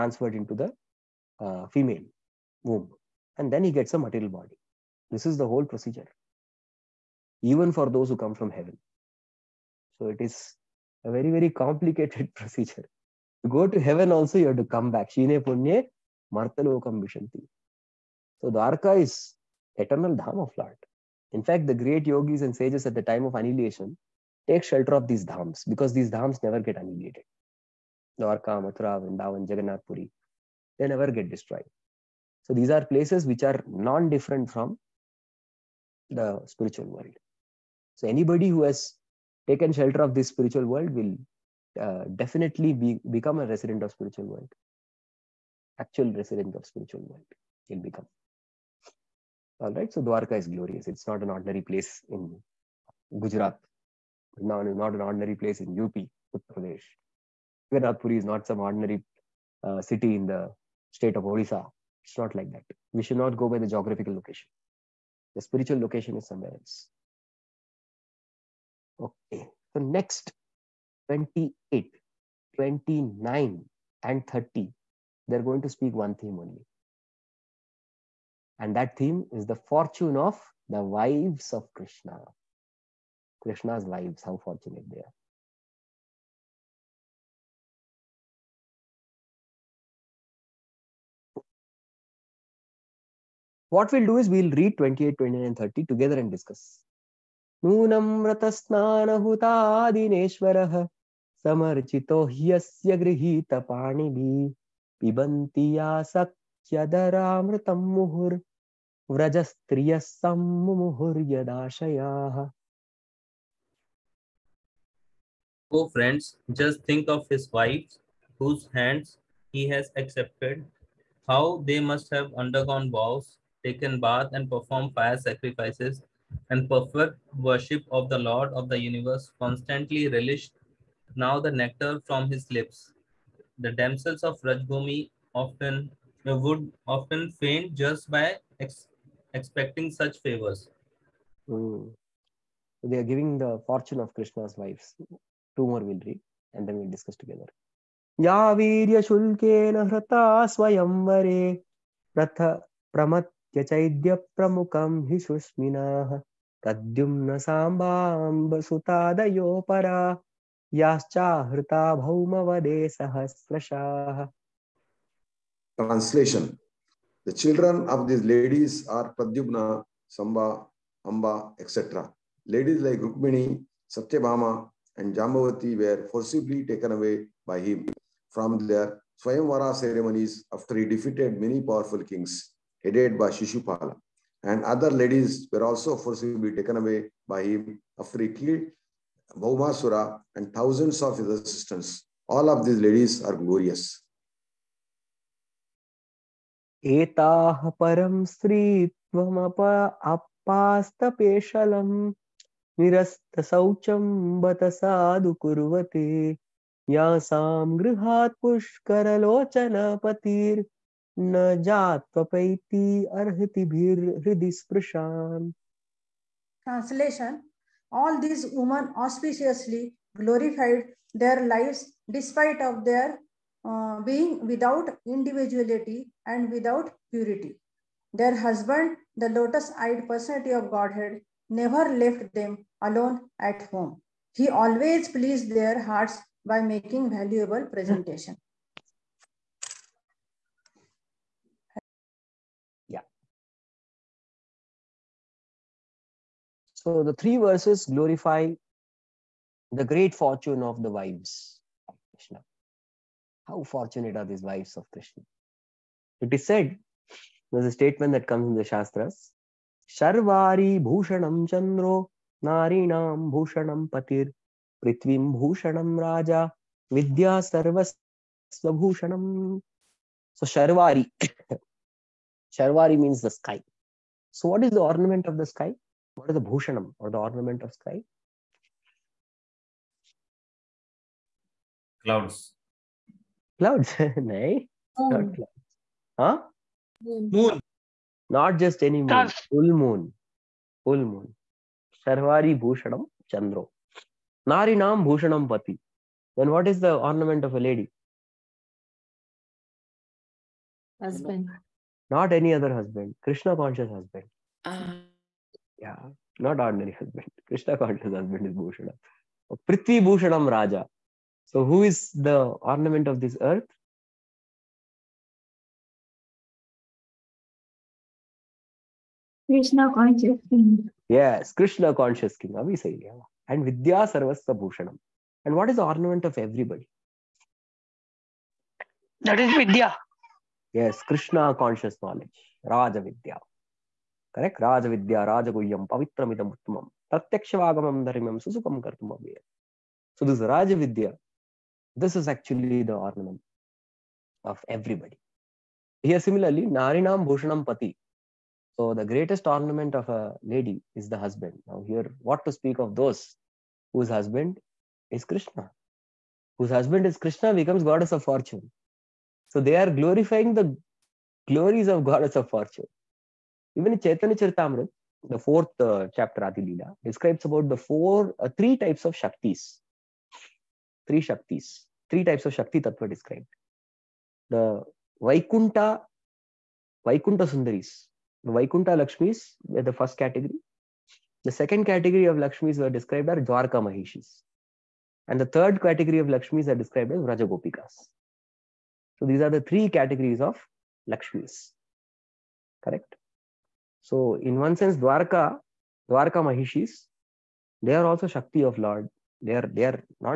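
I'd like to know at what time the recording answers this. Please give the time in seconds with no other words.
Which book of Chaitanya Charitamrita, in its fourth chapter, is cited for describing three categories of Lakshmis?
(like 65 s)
366 s.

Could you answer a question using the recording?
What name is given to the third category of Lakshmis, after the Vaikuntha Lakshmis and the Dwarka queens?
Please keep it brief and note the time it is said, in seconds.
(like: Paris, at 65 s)
Rajagopikas, at 387 s.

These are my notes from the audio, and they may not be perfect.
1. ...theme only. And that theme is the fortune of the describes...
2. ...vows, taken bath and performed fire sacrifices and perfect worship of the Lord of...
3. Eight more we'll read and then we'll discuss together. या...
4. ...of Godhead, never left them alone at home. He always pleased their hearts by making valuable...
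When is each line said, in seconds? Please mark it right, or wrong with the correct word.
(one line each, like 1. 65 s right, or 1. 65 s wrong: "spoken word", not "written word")
1. 76 s wrong: "wives", not "describes"
2. 122 s right
3. 145 s wrong: "Two", not "Eight"
4. 230 s right.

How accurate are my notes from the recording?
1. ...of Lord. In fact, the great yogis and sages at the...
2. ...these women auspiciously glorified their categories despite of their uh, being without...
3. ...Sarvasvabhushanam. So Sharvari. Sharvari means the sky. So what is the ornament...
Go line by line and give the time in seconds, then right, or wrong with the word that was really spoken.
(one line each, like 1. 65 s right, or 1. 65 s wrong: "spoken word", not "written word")
1. 20 s right
2. 218 s wrong: "lives", not "categories"
3. 267 s right.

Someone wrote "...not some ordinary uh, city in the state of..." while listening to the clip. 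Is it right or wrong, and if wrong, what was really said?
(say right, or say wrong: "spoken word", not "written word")
right.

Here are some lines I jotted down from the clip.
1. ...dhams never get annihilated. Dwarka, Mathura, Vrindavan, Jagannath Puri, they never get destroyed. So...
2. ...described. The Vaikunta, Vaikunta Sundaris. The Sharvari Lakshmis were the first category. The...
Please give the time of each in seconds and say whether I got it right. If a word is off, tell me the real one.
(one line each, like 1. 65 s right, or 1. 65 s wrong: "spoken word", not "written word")
1. 26 s right
2. 373 s wrong: "Vaikunta", not "Sharvari".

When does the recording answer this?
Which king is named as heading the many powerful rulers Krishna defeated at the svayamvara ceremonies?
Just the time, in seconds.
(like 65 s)
183 s.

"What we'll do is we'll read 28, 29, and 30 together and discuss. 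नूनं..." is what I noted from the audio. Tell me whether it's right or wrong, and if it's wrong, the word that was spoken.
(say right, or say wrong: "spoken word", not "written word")
right.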